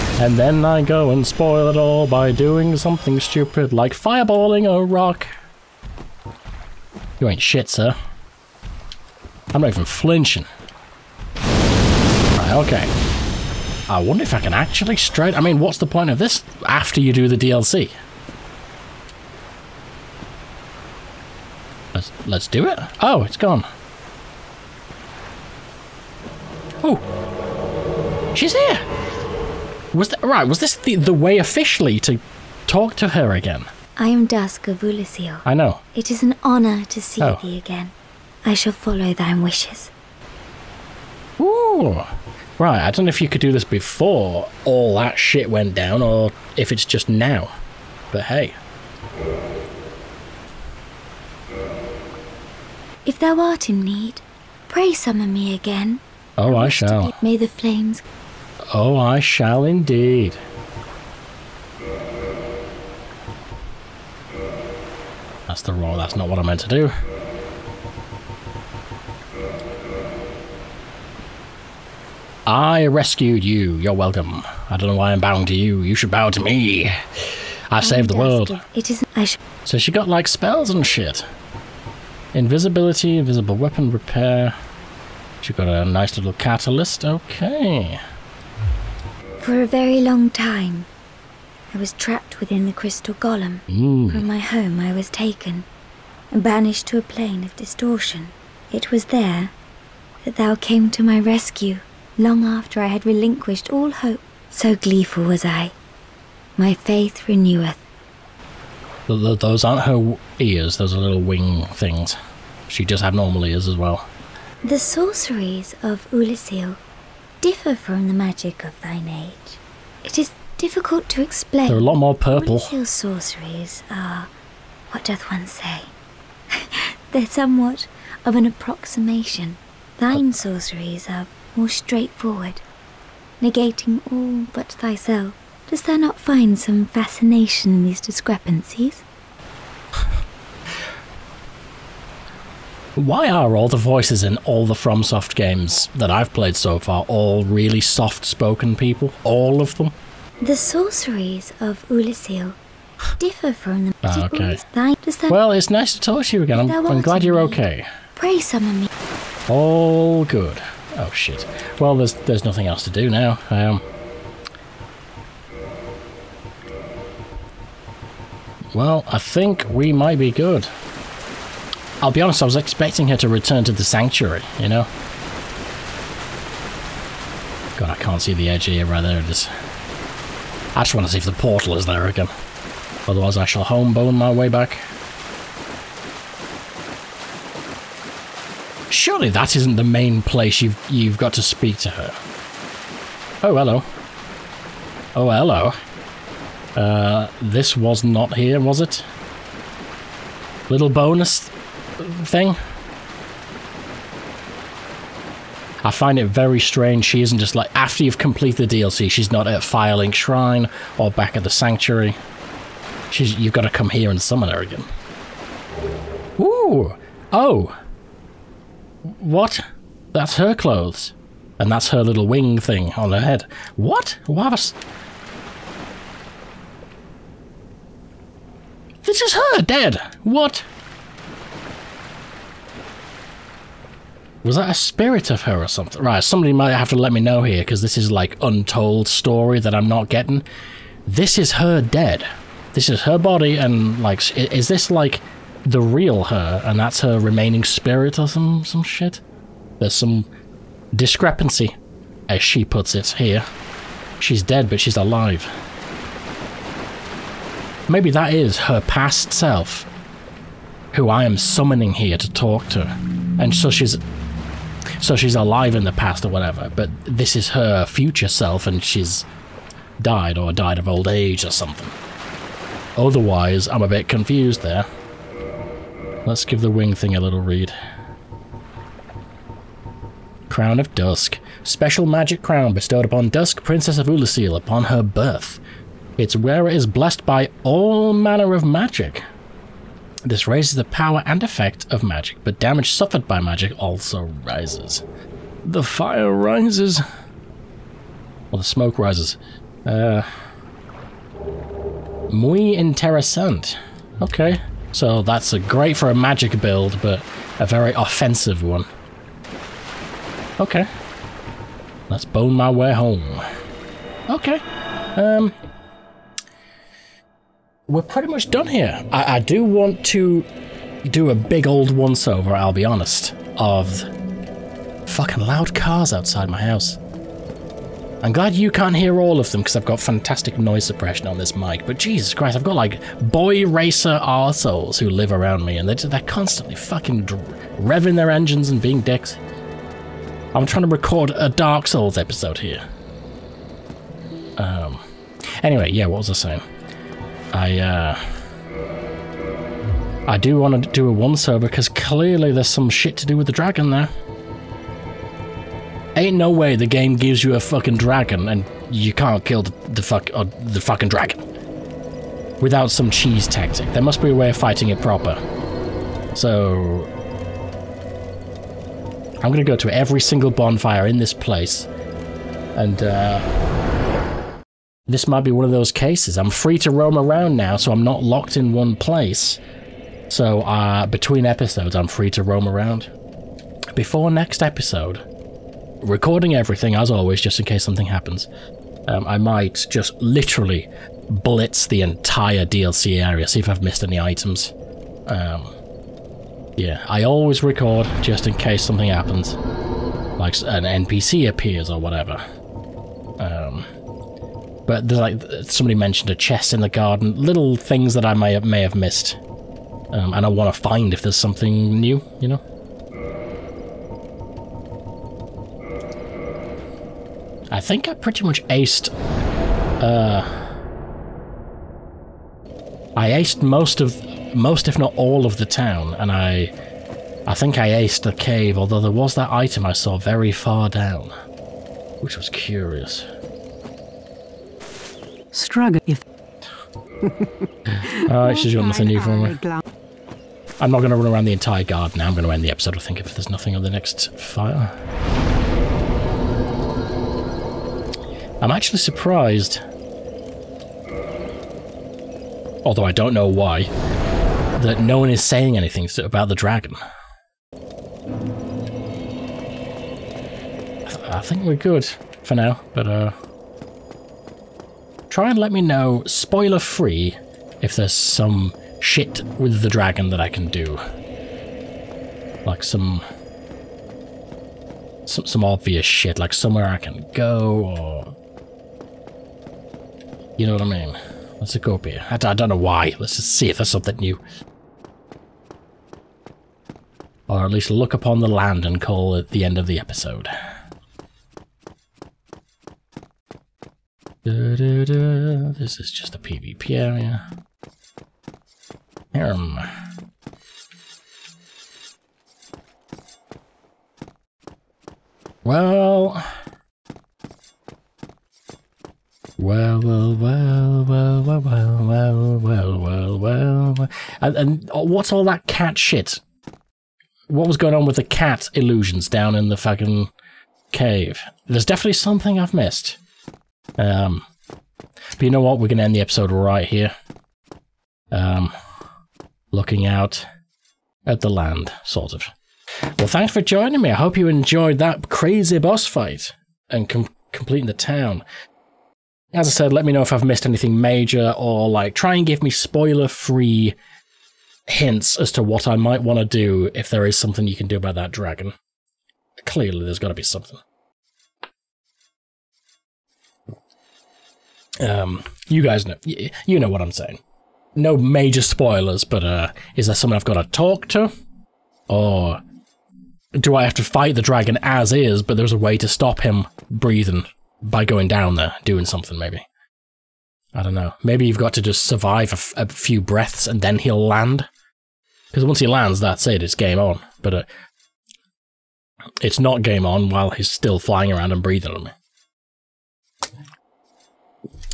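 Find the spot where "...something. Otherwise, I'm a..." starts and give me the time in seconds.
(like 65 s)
271 s.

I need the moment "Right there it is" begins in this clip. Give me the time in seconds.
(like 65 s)
178 s.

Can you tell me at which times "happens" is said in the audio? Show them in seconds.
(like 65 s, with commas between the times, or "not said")
388 s, 399 s.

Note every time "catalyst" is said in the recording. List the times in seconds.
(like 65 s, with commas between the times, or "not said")
86 s.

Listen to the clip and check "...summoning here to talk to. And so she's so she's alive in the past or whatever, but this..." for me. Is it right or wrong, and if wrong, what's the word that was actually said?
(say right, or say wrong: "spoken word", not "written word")
right.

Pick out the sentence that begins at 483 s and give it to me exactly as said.
Let's just see if there's something new.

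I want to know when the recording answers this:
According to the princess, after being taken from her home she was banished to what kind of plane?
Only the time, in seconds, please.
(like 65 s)
97 s.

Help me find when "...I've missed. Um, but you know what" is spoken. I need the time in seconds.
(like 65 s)
522 s.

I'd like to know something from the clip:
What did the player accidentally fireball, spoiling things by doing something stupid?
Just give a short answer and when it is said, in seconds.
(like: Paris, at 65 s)
A rock, at 4 s.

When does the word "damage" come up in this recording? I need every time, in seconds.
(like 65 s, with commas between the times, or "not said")
292 s.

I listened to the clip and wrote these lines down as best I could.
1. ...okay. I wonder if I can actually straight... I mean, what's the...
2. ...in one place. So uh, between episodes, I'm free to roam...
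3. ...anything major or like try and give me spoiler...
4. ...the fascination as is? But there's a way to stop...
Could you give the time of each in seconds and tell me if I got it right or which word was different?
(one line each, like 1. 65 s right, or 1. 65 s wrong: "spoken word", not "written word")
1. 12 s right
2. 378 s right
3. 540 s right
4. 564 s wrong: "dragon", not "fascination".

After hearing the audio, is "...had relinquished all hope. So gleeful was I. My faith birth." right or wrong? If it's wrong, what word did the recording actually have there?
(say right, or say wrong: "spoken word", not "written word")
wrong: "reneweth", not "birth".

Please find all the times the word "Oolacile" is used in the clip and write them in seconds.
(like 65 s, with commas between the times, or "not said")
34 s, 116 s, 151 s, 284 s.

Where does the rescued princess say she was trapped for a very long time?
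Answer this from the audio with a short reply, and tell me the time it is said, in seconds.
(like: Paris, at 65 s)
Within the crystal golem, at 92 s.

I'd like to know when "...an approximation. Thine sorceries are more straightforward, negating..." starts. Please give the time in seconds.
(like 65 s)
128 s.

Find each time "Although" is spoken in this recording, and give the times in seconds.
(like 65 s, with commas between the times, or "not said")
428 s, 452 s.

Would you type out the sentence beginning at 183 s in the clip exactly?
Otherwise, I shall homebone my way back.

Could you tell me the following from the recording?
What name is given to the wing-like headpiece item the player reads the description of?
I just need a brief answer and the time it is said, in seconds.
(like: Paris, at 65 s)
Crown of Dusk, at 280 s.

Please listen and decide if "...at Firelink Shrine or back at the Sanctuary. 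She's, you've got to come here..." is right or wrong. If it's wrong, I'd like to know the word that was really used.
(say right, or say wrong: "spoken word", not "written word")
right.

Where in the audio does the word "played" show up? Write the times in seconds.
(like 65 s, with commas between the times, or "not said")
146 s.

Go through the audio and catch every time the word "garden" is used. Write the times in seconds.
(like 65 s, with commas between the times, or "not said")
406 s, 441 s.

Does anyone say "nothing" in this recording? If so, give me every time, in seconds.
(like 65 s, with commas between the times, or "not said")
162 s, 438 s, 443 s.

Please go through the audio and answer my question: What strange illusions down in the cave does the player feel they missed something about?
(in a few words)
Cat illusions.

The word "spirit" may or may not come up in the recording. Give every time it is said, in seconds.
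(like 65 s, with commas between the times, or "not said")
234 s, 247 s.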